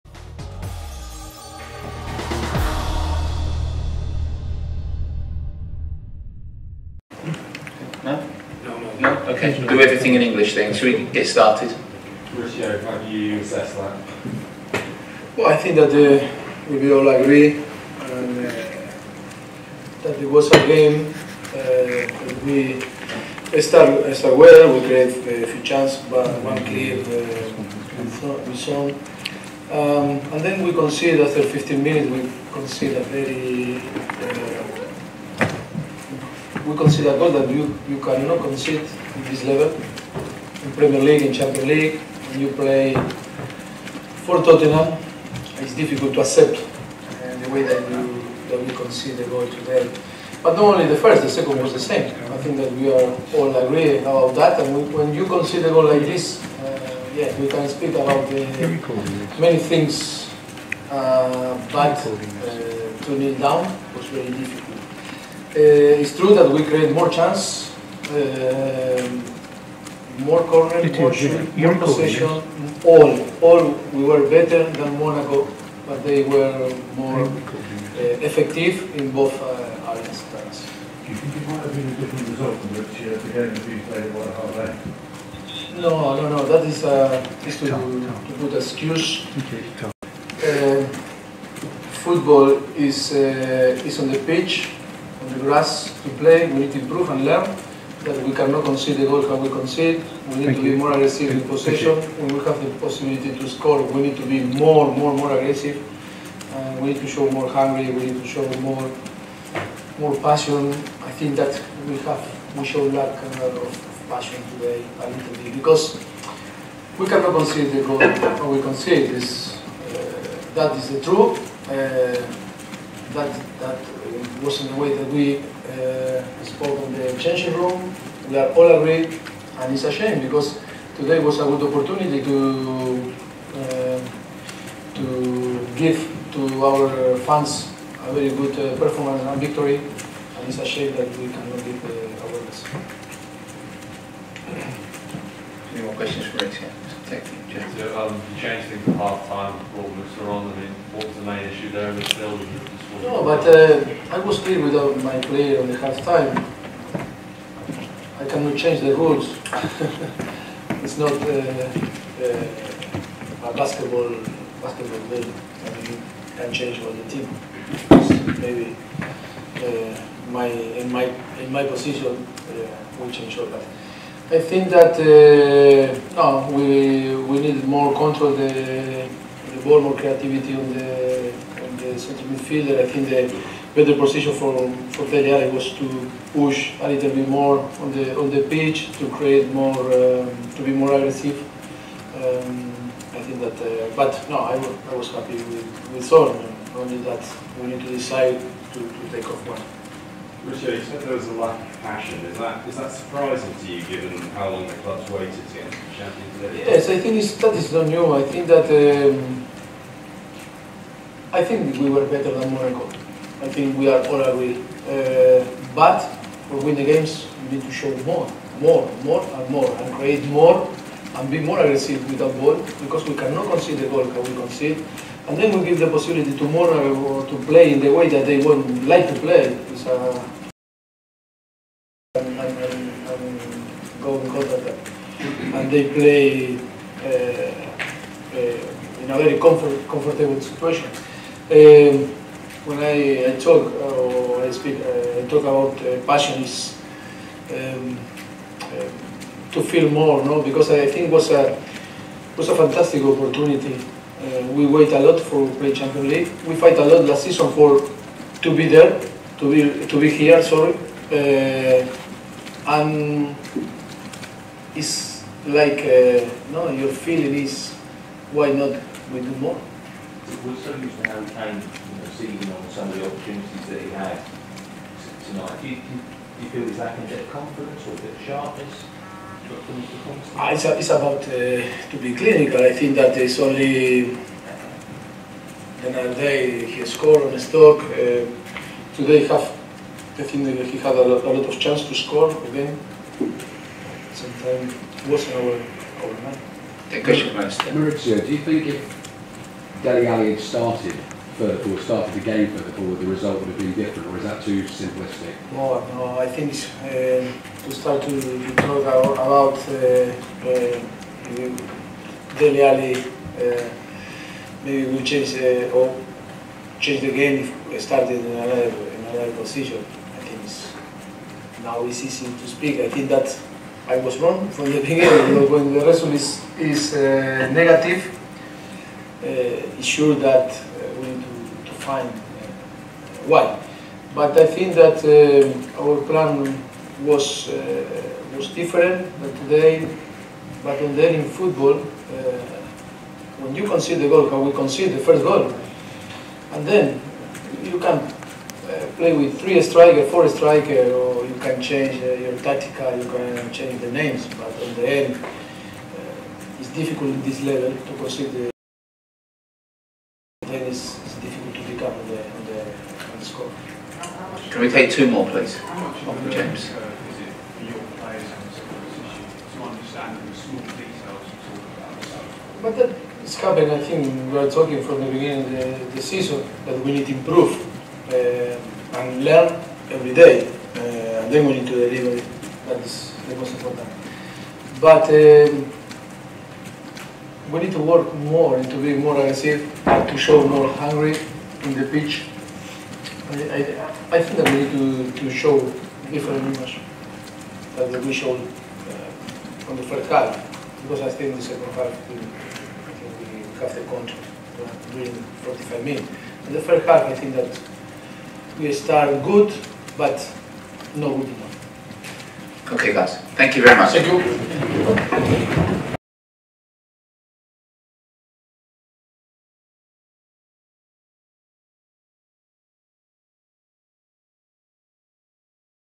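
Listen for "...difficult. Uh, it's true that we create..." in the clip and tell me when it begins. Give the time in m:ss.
1:04.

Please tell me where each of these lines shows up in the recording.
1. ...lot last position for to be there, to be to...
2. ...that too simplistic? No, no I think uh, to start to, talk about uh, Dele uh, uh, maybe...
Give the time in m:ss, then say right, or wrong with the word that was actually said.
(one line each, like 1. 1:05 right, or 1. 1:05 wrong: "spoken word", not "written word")
1. 4:16 wrong: "season", not "position"
2. 5:04 right.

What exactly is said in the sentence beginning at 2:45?
I mean, you can change for the team.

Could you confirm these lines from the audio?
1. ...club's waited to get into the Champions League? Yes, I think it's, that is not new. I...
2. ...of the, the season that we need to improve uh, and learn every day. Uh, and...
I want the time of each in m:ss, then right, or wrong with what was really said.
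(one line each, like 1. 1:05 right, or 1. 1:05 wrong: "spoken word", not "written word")
1. 3:24 right
2. 6:15 right.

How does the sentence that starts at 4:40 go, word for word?
It's, it's about uh, to be clinical.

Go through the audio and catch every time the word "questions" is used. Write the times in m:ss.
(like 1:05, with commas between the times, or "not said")
2:26, 4:57.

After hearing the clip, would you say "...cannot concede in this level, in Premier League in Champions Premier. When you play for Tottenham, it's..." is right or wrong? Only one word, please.
wrong.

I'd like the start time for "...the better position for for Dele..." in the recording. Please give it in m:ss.
3:03.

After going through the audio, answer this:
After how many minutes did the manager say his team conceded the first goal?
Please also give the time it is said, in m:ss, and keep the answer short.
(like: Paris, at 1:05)
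15, at 0:31.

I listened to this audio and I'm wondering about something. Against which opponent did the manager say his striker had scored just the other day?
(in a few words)
Stoke.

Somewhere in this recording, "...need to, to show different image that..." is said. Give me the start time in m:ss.
6:34.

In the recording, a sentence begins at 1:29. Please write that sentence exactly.
Uh, um, football is uh, is on the pitch, on the grass to play.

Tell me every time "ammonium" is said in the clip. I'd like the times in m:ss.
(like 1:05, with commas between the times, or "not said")
not said.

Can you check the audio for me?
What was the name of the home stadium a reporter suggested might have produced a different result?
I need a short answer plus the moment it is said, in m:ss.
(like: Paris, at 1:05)
White Hart Lane, at 1:24.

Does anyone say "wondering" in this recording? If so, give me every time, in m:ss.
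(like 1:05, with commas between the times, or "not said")
not said.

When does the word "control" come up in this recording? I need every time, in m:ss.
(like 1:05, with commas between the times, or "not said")
2:57, 6:43.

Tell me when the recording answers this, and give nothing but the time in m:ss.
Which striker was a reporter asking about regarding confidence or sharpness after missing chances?
4:31.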